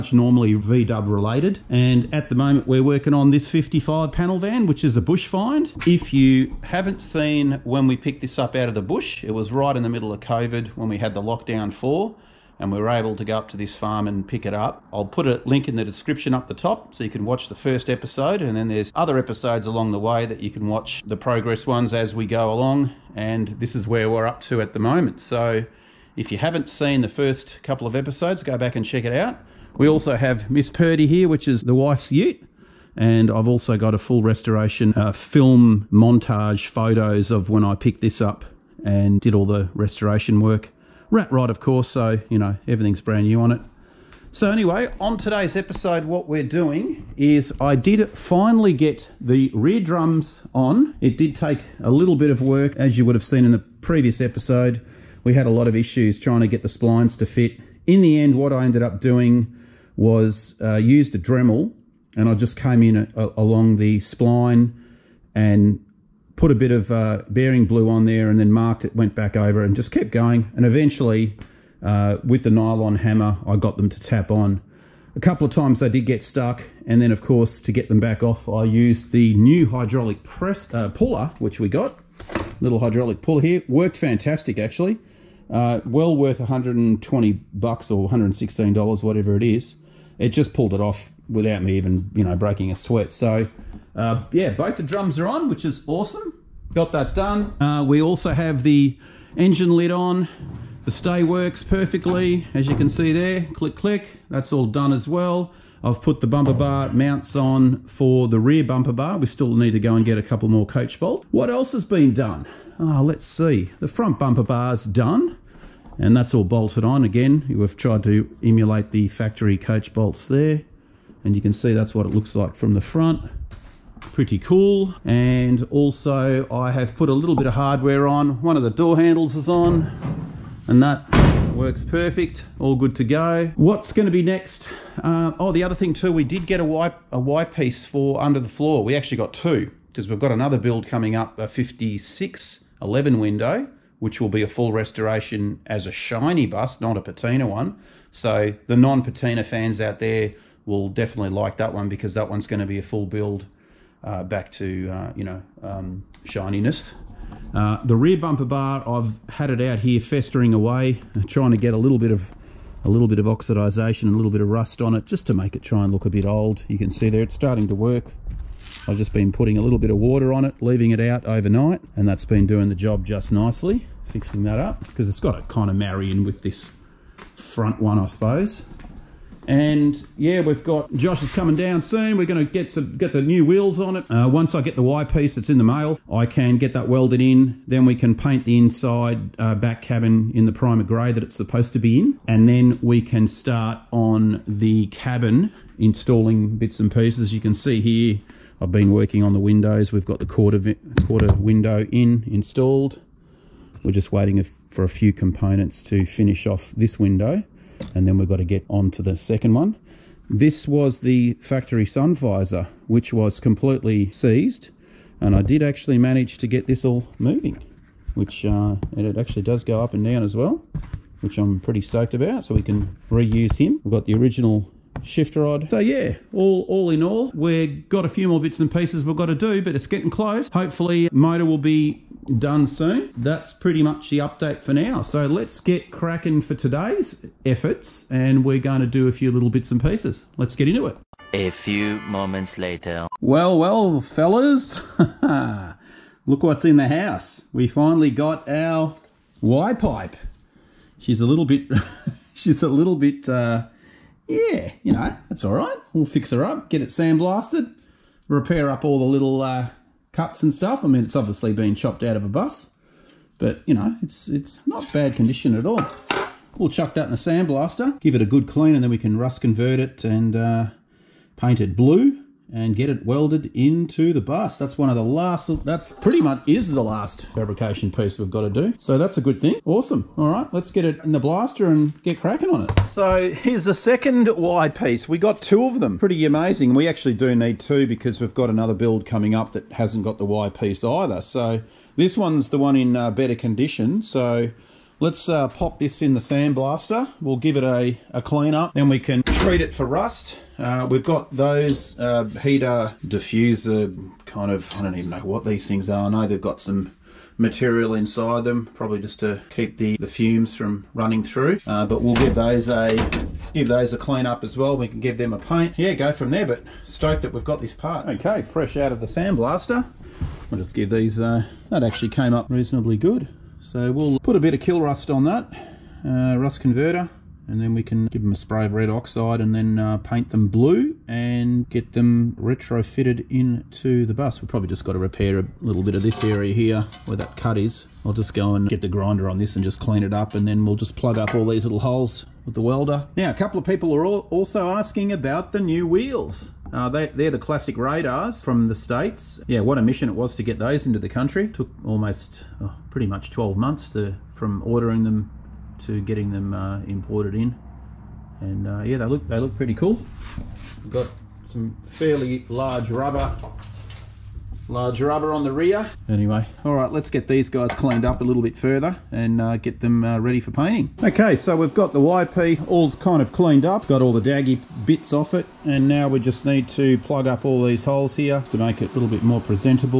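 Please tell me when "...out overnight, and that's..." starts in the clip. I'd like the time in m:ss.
2:51.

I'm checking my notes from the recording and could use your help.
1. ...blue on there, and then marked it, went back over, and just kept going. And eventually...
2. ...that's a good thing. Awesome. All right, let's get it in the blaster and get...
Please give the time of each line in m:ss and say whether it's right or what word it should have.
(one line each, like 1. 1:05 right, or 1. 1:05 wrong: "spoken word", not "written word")
1. 1:07 right
2. 4:38 right.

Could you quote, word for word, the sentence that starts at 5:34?
We've probably just got to repair a little bit of this area here where that cut is.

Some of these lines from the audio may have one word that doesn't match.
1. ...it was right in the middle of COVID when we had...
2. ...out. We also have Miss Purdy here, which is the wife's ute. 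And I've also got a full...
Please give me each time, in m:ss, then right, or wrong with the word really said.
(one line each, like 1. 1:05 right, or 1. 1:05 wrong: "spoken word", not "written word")
1. 0:09 right
2. 0:29 right.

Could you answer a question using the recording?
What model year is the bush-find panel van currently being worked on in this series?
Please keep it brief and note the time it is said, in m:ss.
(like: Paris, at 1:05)
55, at 0:03.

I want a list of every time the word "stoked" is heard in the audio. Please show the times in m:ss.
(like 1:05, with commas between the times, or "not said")
3:41, 5:16.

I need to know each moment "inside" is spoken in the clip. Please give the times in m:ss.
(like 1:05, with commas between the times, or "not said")
3:08, 5:07.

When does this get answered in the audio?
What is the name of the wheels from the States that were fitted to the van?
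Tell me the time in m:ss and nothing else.
5:47.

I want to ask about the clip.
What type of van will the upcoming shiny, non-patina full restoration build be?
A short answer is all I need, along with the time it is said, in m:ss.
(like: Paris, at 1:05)
56 11 window, at 2:21.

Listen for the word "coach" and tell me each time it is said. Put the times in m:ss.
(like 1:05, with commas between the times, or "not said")
1:50, 1:59.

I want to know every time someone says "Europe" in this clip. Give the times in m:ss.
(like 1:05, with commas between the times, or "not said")
not said.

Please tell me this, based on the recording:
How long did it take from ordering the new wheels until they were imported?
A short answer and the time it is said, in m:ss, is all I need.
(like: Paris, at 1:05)
12 months, at 5:53.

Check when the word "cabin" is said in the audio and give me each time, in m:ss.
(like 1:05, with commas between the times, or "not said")
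3:09, 3:14.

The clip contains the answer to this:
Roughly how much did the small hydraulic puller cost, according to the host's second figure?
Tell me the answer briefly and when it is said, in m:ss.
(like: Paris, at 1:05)
116 dollars, at 1:28.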